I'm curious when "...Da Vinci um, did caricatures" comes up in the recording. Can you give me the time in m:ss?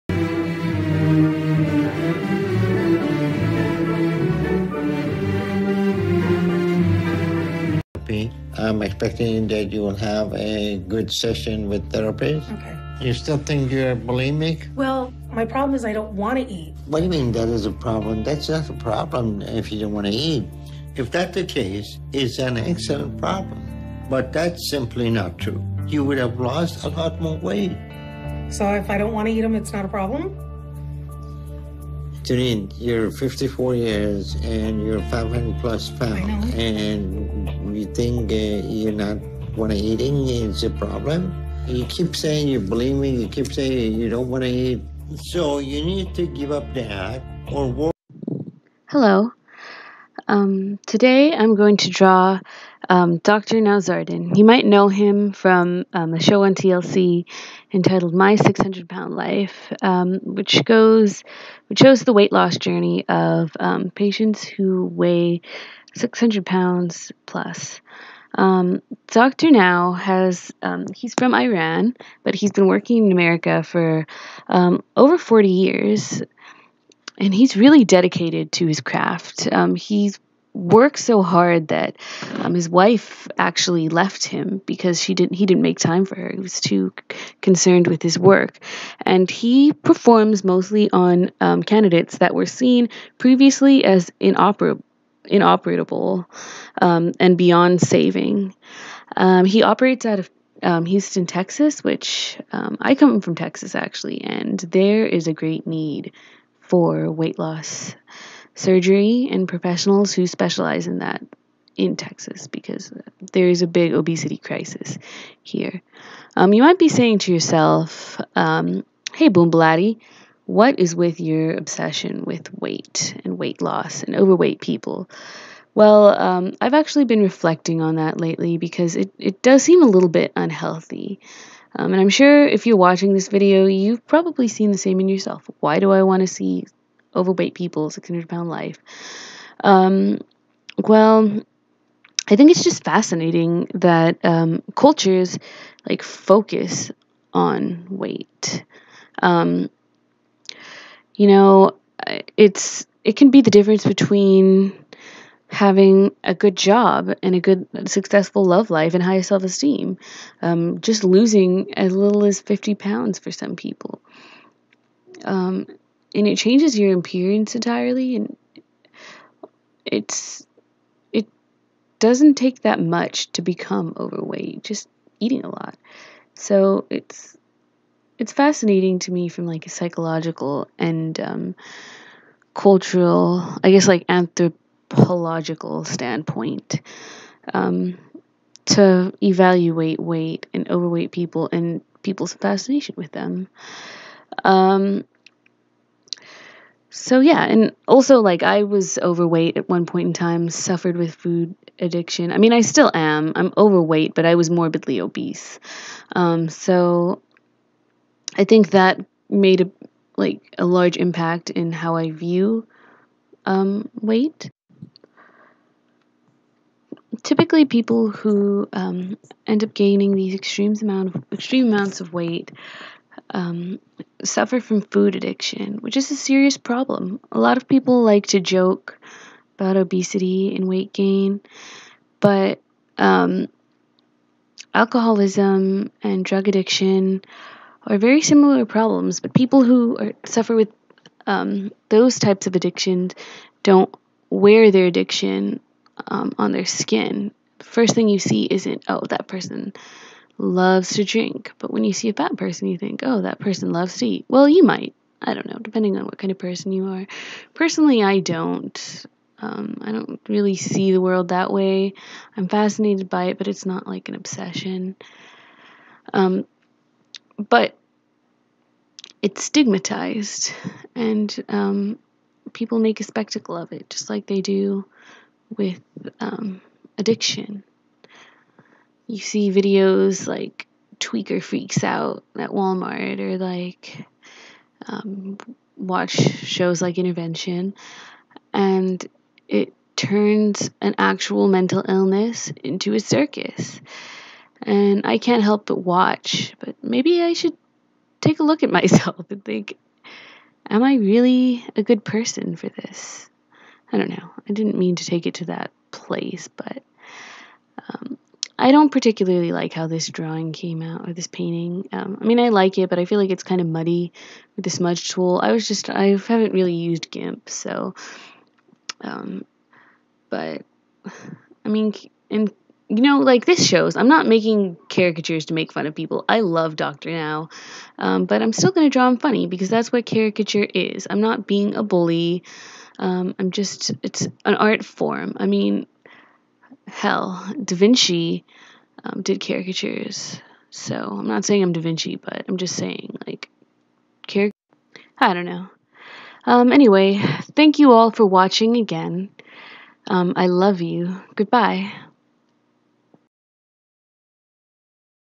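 5:37.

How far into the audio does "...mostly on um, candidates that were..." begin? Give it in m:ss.
1:30.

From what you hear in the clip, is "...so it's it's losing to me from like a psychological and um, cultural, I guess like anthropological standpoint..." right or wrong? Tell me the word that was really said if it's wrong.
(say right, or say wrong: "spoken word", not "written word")
wrong: "fascinating", not "losing".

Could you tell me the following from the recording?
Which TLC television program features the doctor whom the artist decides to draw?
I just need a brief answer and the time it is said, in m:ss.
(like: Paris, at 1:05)
My 600 Pound Life, at 0:58.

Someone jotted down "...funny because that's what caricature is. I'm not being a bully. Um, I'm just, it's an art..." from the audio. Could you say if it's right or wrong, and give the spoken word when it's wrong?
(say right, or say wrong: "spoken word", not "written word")
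right.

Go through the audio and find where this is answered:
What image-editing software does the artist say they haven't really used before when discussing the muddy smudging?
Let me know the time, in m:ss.
5:17.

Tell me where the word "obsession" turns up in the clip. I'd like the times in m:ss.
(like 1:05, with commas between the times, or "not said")
2:01, 4:24.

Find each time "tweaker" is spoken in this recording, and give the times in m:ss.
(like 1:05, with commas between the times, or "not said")
4:40.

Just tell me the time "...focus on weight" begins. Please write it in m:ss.
2:26.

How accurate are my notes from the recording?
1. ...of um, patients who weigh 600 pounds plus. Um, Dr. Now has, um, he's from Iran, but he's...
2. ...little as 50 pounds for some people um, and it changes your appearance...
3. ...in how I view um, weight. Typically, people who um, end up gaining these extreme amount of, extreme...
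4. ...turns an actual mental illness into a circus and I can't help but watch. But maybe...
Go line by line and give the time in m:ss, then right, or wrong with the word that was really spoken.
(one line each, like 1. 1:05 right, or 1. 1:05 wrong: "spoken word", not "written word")
1. 1:03 right
2. 2:41 right
3. 3:31 right
4. 4:49 right.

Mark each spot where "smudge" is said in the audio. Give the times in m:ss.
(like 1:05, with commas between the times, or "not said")
5:14.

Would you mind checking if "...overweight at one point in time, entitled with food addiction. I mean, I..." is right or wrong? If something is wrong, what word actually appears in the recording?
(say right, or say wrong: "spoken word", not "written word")
wrong: "suffered", not "entitled".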